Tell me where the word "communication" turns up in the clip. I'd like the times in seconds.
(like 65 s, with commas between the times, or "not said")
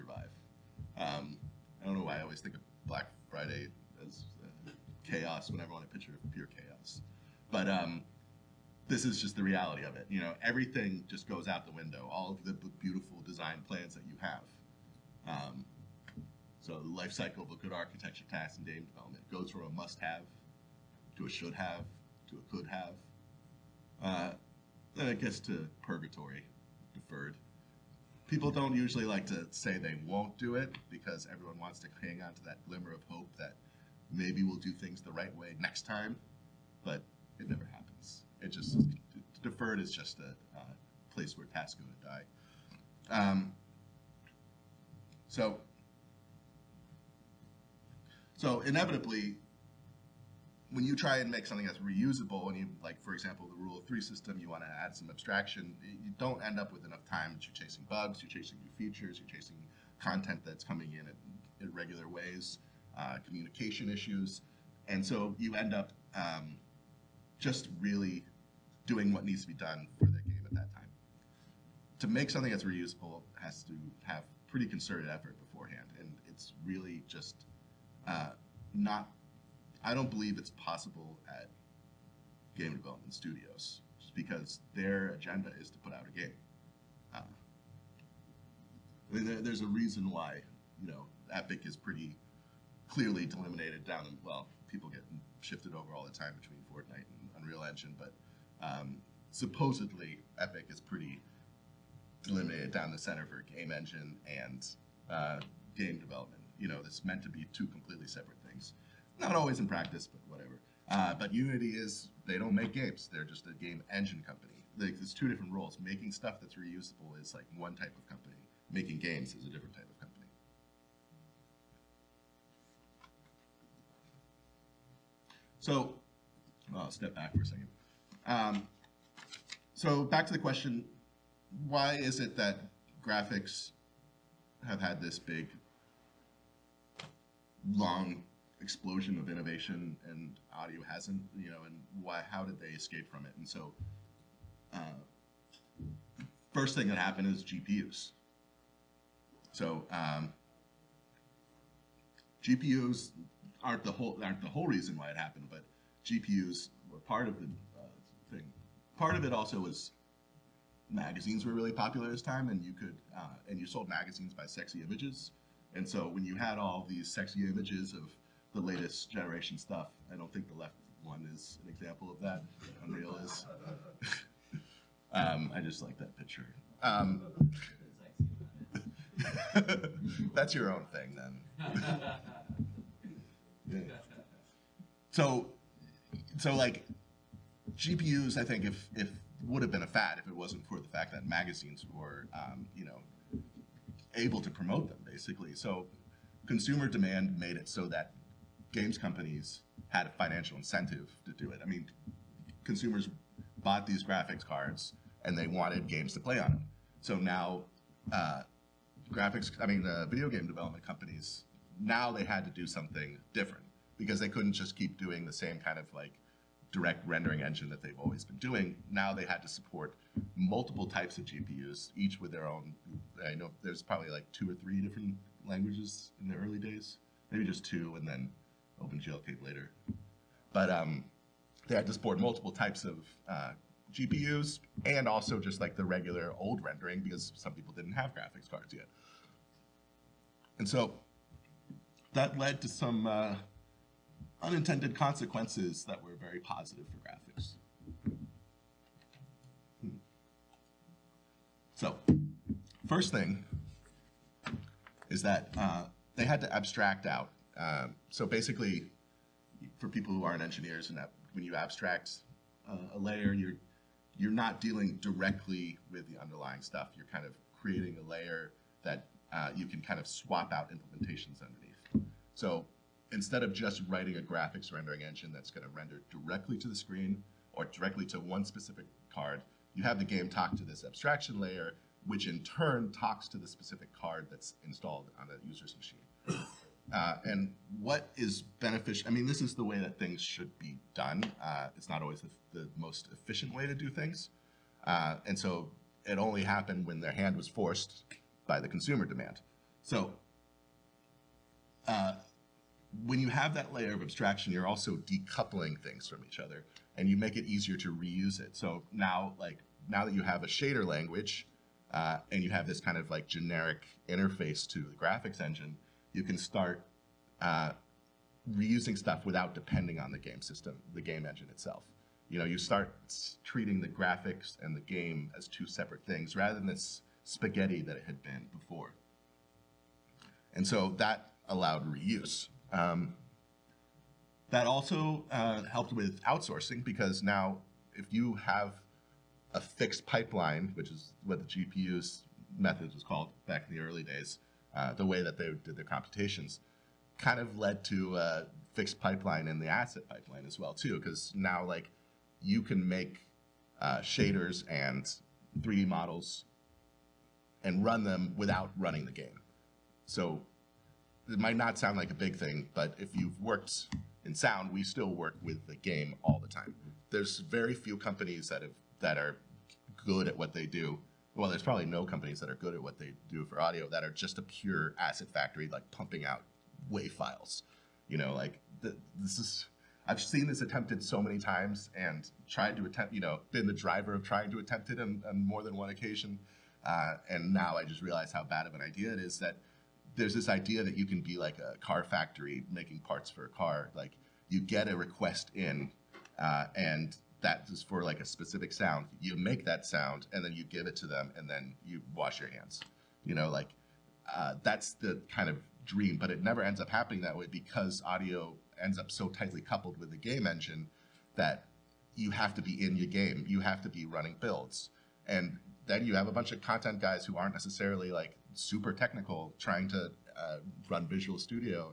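63 s.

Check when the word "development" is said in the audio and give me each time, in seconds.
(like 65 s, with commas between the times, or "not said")
18 s, 82 s, 105 s, 210 s.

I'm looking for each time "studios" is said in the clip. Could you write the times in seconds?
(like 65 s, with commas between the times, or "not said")
83 s, 421 s.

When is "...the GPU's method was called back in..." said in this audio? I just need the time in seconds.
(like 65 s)
341 s.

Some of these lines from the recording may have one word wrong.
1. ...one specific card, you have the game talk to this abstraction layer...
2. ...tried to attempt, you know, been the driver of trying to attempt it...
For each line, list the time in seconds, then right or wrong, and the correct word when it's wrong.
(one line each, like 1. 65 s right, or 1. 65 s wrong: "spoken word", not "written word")
1. 278 s right
2. 382 s right.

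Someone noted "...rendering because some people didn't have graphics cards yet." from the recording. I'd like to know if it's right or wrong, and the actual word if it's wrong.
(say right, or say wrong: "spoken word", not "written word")
right.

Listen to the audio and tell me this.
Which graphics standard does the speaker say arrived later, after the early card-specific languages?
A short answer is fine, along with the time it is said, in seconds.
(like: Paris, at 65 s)
OpenGL, at 228 s.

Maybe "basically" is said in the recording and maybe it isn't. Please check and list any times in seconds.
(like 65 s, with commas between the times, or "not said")
195 s, 258 s.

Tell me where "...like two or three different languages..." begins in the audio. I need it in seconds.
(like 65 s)
224 s.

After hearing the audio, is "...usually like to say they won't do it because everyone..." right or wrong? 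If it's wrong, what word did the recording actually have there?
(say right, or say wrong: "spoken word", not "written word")
right.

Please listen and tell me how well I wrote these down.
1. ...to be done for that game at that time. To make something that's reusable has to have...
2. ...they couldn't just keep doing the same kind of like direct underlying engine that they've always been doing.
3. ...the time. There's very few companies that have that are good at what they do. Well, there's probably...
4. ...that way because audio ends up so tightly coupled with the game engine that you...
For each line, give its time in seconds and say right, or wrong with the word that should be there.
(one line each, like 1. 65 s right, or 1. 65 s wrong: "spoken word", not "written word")
1. 69 s right
2. 214 s wrong: "rendering", not "underlying"
3. 366 s right
4. 407 s right.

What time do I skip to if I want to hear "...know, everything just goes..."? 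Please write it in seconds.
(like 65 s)
10 s.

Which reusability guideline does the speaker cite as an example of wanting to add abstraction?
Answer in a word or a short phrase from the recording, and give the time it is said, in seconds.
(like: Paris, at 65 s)
Rule of three, at 53 s.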